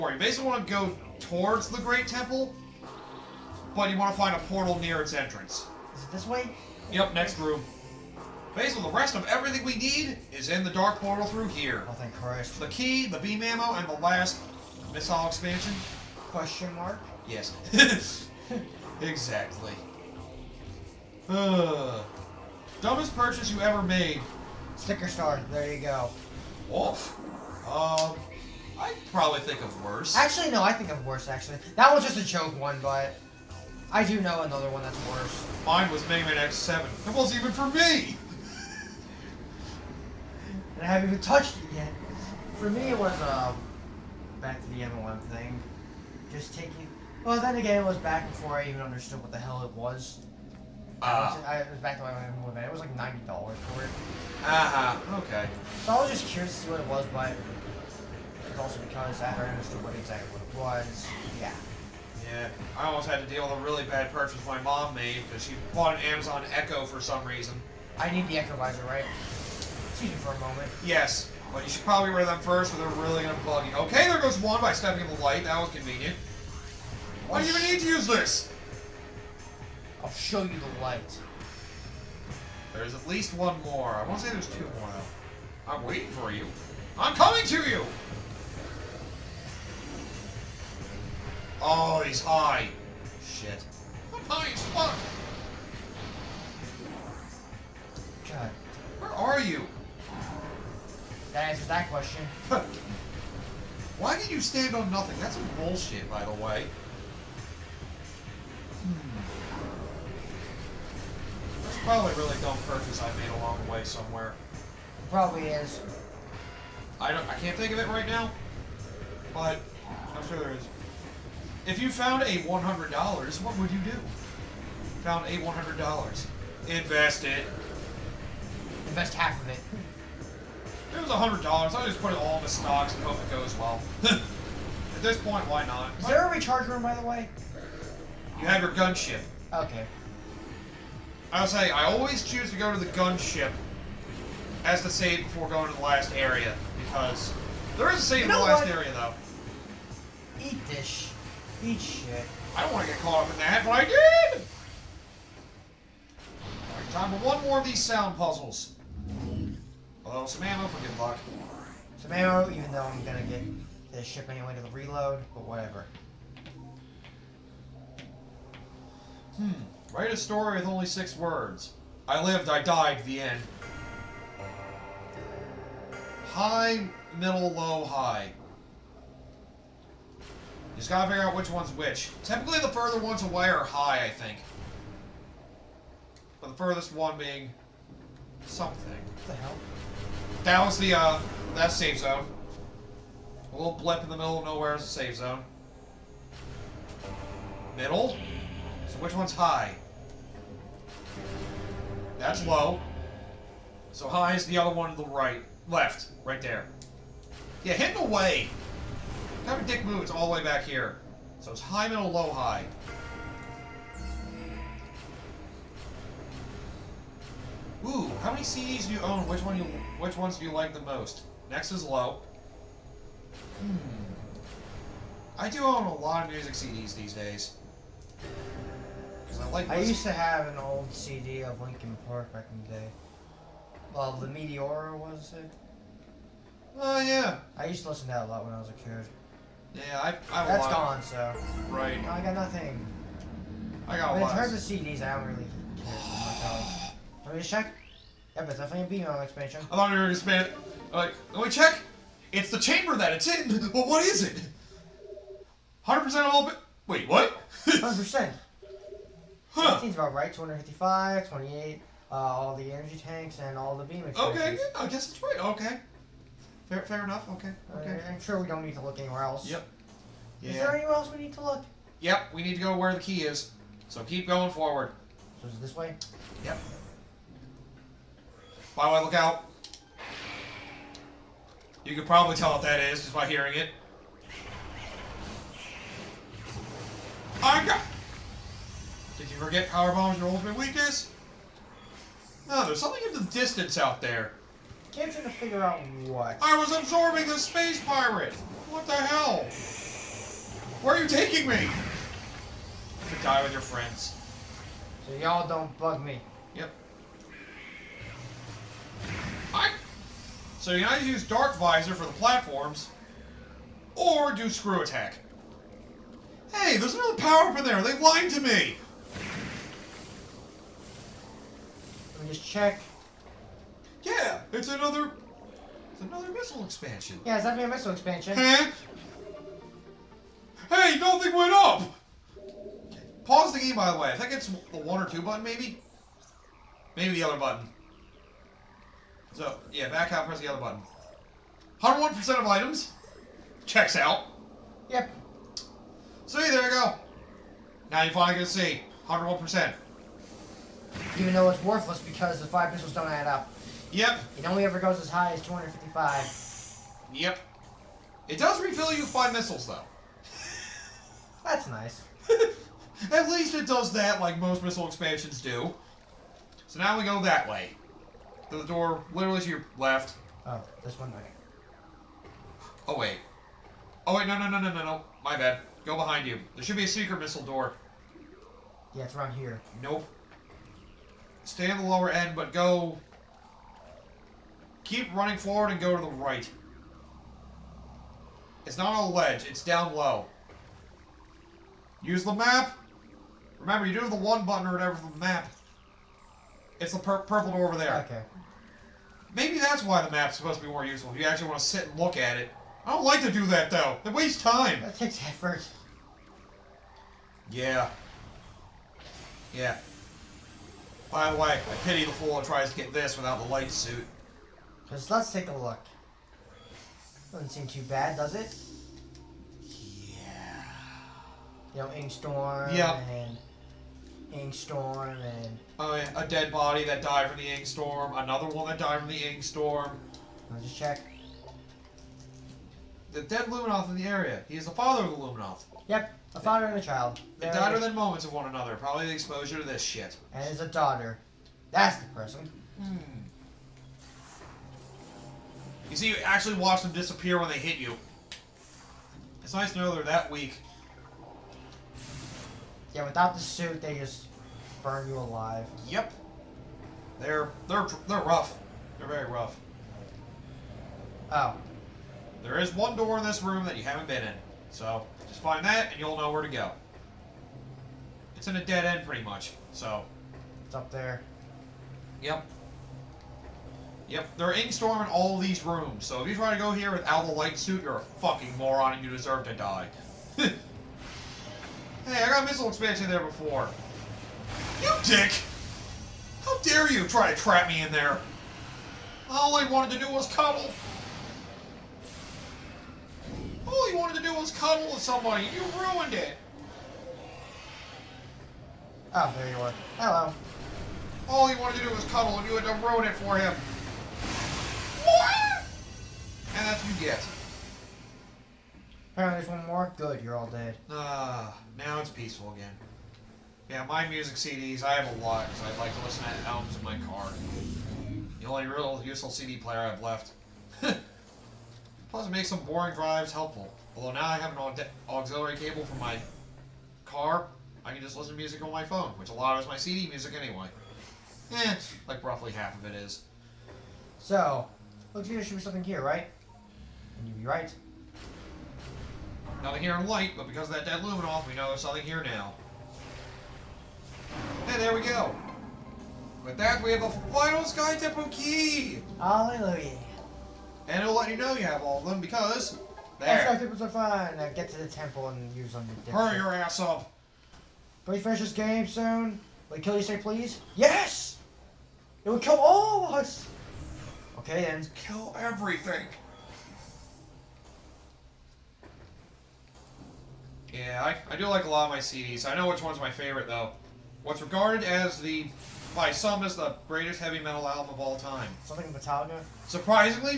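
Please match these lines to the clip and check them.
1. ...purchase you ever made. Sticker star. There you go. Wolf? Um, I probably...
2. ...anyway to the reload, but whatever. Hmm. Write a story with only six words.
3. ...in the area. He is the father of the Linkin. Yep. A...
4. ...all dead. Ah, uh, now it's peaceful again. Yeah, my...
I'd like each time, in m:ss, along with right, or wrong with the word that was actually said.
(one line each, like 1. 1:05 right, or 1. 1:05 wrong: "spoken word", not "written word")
1. 0:23 right
2. 2:44 right
3. 7:13 wrong: "Luminoth", not "Linkin"
4. 8:30 right.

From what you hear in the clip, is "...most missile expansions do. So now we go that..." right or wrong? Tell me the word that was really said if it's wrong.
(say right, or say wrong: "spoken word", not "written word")
right.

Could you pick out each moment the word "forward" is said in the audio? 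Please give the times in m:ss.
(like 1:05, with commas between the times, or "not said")
4:34, 6:25.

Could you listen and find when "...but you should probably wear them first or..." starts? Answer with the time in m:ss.
1:11.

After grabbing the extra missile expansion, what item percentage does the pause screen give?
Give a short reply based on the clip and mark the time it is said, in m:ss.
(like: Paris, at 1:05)
101%, at 5:41.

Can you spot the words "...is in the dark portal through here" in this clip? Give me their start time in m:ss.
0:10.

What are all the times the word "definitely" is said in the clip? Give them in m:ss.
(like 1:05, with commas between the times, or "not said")
4:08, 5:27.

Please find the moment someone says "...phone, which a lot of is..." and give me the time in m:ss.
8:48.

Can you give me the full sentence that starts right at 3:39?
Which one you which ones do you like the most?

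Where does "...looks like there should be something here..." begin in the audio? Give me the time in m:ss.
8:55.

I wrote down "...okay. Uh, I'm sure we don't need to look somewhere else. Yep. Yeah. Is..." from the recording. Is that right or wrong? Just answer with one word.
wrong.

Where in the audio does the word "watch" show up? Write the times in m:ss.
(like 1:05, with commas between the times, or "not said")
7:26.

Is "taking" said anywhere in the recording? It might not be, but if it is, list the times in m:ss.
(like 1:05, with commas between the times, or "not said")
0:46, 5:01.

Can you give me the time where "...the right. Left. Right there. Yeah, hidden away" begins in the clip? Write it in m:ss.
3:24.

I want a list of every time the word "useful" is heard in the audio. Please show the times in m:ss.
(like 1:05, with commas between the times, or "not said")
6:40, 8:39.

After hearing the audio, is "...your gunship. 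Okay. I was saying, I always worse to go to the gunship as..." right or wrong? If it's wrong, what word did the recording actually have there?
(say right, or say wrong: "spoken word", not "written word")
wrong: "choose", not "worse".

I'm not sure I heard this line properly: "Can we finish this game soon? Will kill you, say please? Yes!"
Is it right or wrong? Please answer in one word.
right.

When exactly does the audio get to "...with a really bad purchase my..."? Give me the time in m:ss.
1:03.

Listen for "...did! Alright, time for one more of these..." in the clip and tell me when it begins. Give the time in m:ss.
2:33.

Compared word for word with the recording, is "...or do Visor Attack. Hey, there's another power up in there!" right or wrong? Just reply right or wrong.
wrong.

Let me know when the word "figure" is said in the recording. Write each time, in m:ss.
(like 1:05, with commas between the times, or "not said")
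3:01, 4:55.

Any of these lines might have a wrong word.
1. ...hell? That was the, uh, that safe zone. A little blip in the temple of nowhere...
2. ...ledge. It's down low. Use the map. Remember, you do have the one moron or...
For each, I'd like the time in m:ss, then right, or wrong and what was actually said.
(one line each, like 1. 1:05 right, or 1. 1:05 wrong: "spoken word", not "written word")
1. 3:09 wrong: "middle", not "temple"
2. 6:29 wrong: "button", not "moron".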